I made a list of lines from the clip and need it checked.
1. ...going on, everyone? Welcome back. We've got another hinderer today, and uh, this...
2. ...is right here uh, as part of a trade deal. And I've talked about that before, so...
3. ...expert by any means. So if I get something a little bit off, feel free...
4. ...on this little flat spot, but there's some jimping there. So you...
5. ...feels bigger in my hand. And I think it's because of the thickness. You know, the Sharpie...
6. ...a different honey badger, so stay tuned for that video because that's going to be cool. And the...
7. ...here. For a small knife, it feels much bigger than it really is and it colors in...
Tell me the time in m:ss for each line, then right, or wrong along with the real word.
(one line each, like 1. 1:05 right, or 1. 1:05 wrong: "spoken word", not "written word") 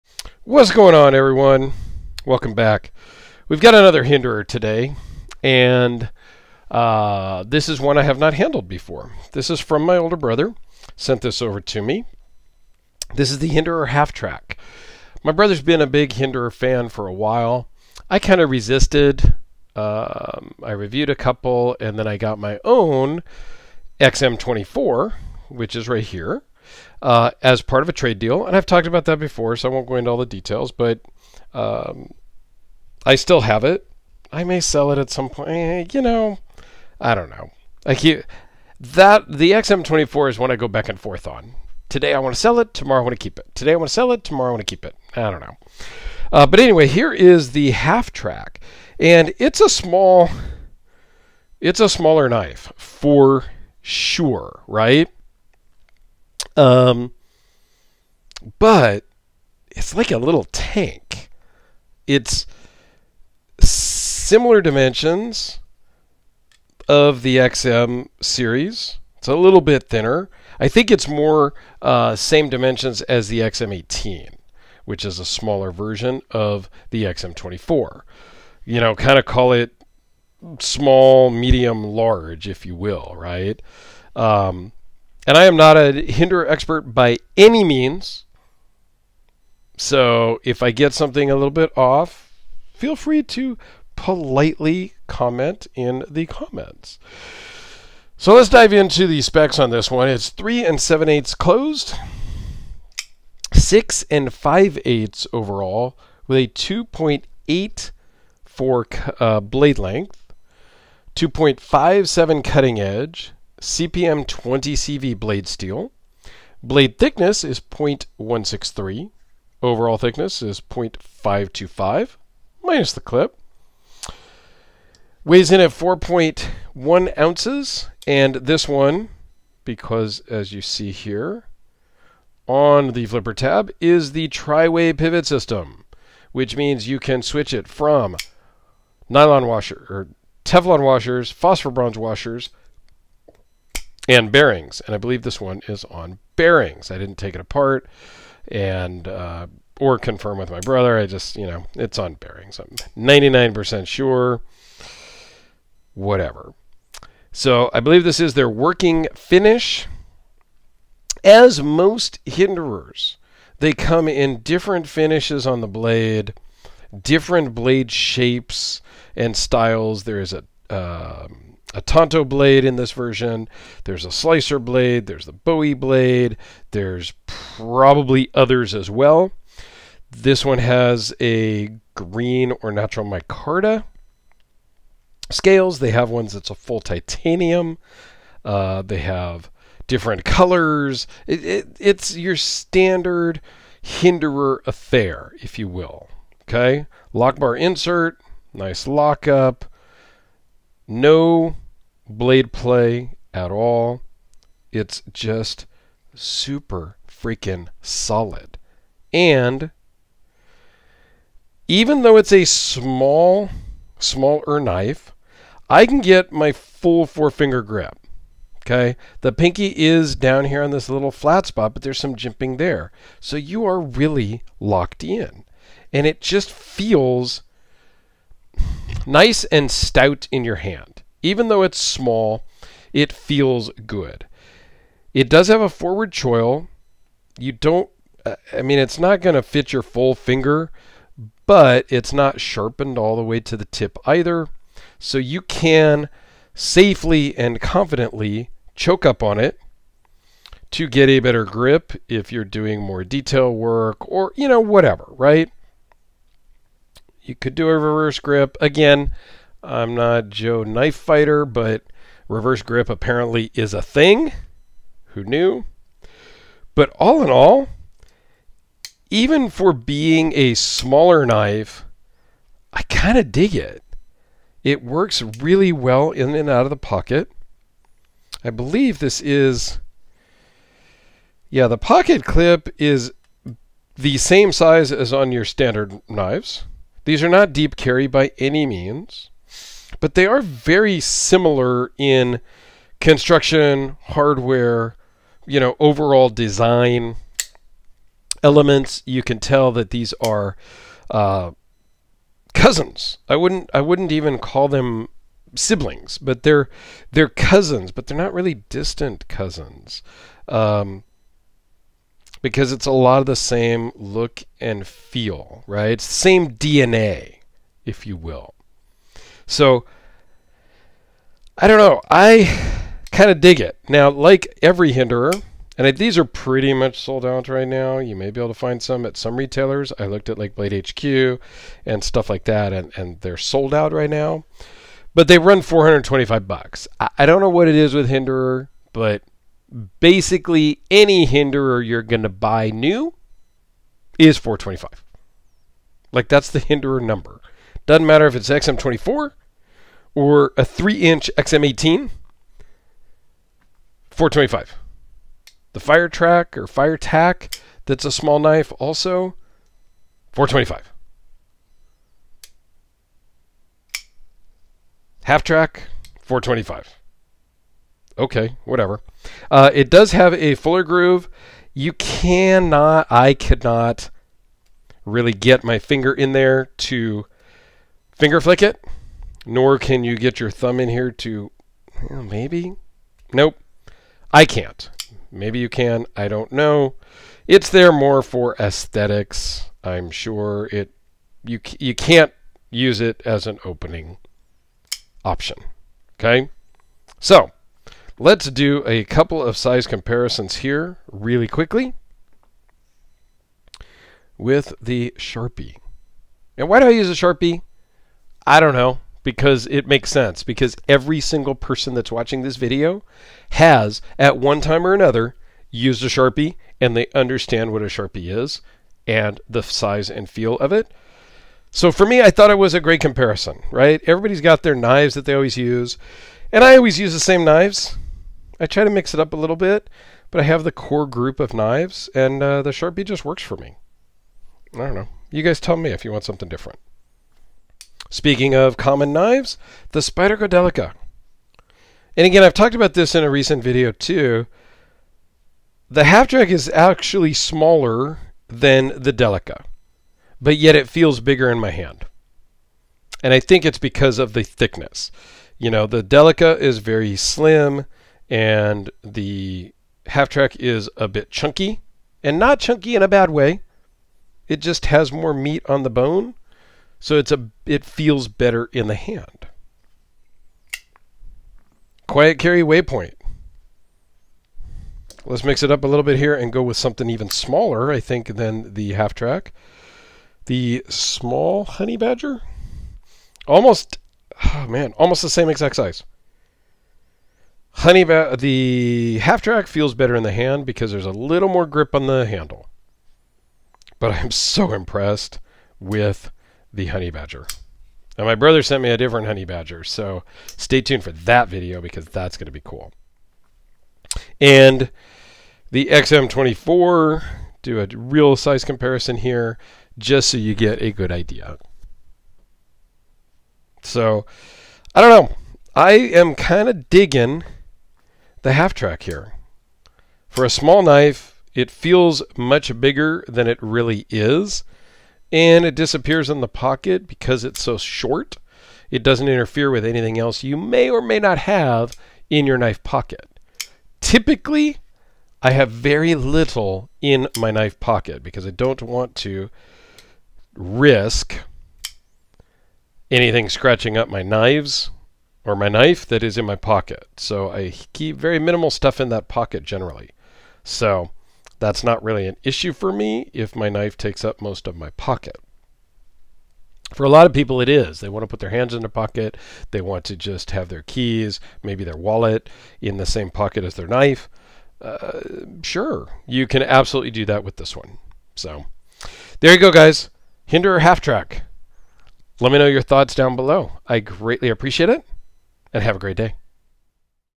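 1. 0:00 right
2. 0:25 right
3. 1:26 right
4. 3:40 right
5. 7:30 wrong: "Delica", not "Sharpie"
6. 8:18 right
7. 8:39 wrong: "disappears", not "colors".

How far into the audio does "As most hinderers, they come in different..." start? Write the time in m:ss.
2:41.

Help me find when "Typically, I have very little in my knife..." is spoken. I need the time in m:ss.
8:54.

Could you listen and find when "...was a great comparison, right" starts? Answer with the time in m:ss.
7:02.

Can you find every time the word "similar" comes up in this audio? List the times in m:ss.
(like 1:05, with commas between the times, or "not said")
1:03, 4:50.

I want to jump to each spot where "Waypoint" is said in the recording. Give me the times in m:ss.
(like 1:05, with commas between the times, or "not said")
7:52.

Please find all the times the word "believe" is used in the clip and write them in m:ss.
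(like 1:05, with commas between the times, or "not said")
2:24, 2:37, 4:38.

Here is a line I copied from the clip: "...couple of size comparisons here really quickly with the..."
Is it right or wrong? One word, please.
right.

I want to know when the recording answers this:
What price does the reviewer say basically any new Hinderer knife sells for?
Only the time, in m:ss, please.
5:35.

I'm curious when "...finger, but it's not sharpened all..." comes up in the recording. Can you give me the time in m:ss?
4:00.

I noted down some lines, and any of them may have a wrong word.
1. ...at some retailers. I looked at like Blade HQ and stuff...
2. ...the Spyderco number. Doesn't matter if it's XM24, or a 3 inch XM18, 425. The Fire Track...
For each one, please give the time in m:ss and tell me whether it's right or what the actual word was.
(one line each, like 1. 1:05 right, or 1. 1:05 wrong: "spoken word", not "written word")
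1. 5:29 right
2. 5:46 wrong: "Hinderer", not "Spyderco".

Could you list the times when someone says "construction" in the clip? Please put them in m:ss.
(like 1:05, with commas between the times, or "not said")
4:52.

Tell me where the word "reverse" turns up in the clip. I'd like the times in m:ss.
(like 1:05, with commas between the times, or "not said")
4:17, 4:22.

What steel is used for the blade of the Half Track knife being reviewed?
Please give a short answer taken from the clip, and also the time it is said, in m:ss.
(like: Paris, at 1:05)
CPM 20CV, at 1:53.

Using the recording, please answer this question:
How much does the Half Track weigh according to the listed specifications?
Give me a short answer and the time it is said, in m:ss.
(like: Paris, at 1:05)
4.1 ounces, at 2:05.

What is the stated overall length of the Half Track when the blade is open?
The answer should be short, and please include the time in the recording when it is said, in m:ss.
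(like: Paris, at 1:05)
6 5/8 inches, at 1:43.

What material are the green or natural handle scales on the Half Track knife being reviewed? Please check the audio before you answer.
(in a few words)
Micarta.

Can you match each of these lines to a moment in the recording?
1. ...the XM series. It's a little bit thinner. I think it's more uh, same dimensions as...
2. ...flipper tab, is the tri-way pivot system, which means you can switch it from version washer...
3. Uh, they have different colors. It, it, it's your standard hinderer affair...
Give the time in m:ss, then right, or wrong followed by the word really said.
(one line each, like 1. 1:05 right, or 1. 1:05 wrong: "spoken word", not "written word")
1. 1:07 right
2. 2:13 wrong: "nylon", not "version"
3. 3:08 right.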